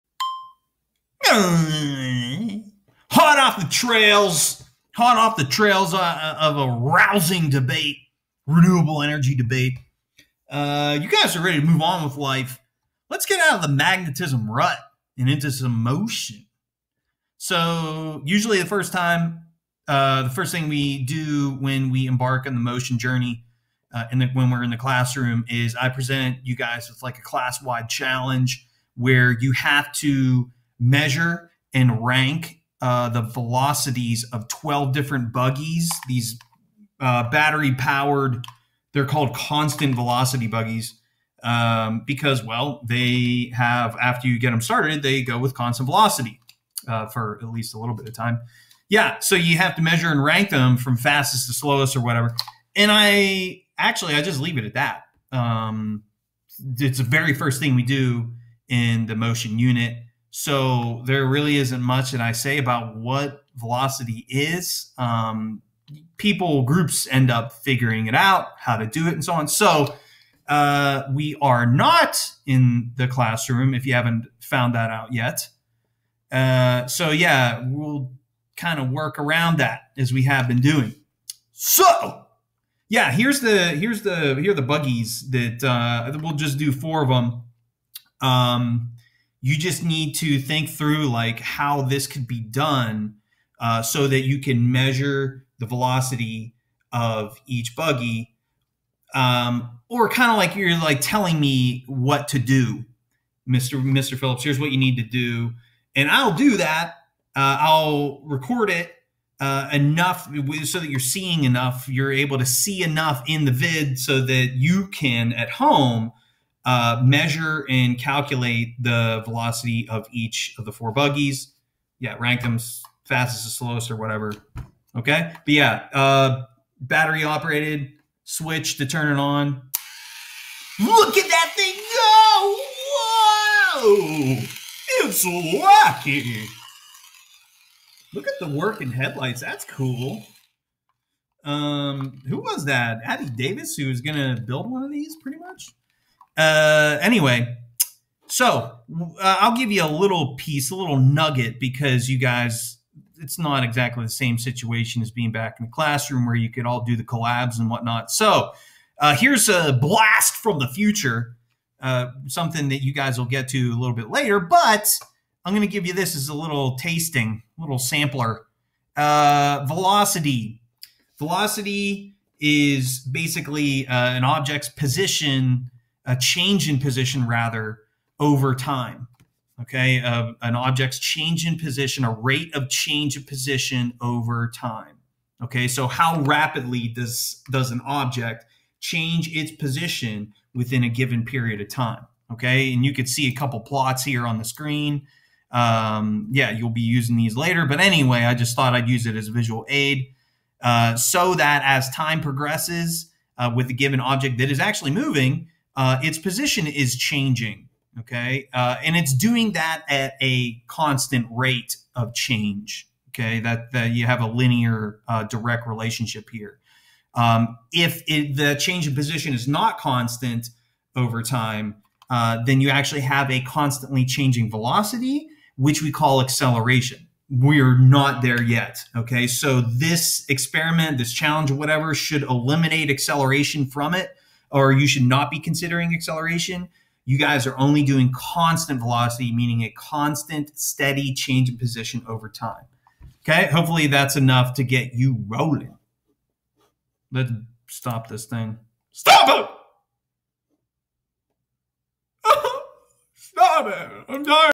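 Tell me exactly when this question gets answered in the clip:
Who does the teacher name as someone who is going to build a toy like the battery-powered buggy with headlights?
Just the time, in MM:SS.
02:23.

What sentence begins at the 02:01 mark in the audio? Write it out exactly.
Yeah, rank them fastest to slowest or whatever.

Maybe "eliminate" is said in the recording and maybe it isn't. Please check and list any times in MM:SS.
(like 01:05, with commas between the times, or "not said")
03:52.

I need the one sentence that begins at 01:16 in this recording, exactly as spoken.
Uh, so yeah, we'll kind of work around that as we have been doing.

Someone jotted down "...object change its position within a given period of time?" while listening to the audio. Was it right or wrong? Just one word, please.
right.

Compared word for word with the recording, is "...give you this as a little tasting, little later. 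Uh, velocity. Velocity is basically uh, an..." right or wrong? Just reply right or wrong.
wrong.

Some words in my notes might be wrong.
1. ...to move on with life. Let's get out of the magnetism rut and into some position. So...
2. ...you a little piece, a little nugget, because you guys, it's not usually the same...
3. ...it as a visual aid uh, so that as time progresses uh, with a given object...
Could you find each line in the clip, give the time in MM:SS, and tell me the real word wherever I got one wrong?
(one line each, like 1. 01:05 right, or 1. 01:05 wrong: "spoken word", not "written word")
1. 00:11 wrong: "motion", not "position"
2. 02:29 wrong: "exactly", not "usually"
3. 03:19 right.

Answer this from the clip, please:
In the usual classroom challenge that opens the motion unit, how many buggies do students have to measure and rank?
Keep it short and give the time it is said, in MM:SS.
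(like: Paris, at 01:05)
12, at 00:34.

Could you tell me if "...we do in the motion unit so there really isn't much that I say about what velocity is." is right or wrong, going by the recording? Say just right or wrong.
right.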